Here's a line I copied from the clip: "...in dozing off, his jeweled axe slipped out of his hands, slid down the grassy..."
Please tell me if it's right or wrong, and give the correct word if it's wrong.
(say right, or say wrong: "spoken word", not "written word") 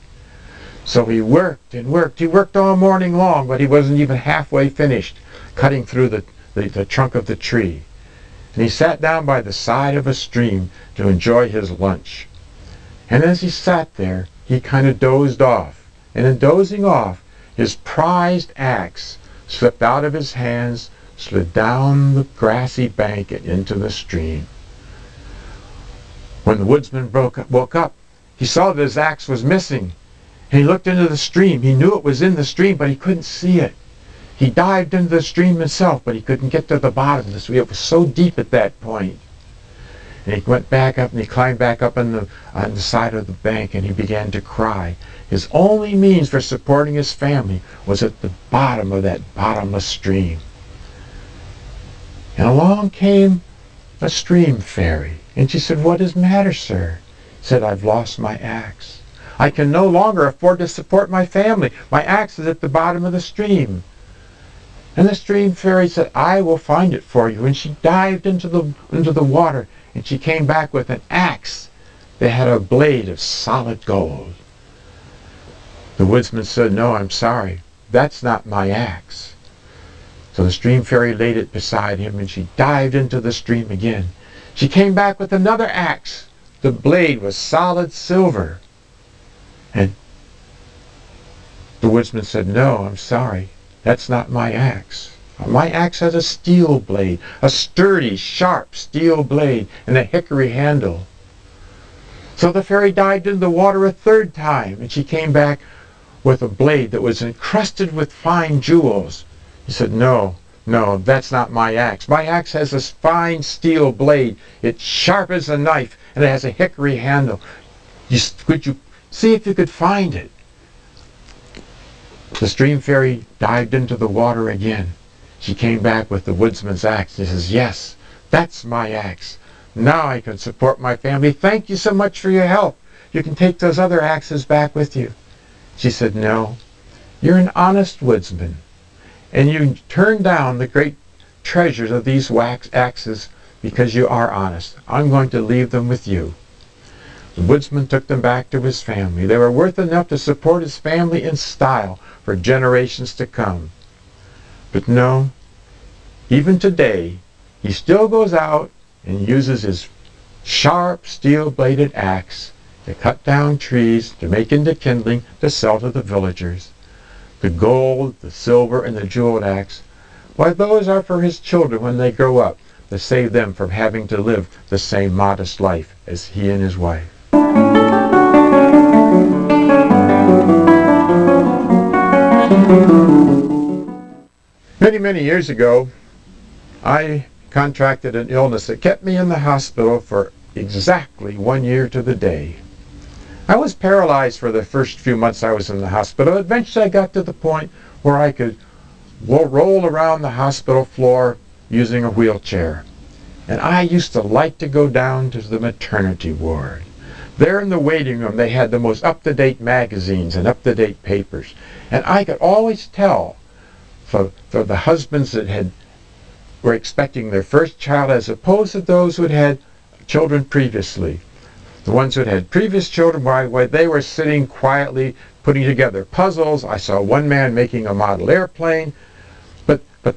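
wrong: "prized", not "jeweled".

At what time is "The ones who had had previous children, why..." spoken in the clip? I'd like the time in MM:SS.
03:41.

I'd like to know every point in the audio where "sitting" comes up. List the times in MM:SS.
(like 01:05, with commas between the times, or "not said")
03:44.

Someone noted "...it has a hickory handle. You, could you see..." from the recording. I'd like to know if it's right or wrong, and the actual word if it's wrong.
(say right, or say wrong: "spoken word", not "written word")
right.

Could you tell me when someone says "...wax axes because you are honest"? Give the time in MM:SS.
02:22.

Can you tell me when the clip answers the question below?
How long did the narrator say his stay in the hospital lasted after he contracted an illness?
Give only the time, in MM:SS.
03:10.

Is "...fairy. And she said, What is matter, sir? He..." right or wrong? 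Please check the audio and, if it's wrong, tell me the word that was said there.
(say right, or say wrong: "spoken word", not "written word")
right.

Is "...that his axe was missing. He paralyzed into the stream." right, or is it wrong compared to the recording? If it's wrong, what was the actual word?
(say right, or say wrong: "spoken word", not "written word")
wrong: "looked", not "paralyzed".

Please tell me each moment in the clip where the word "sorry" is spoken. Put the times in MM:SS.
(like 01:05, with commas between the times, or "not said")
01:17, 01:32.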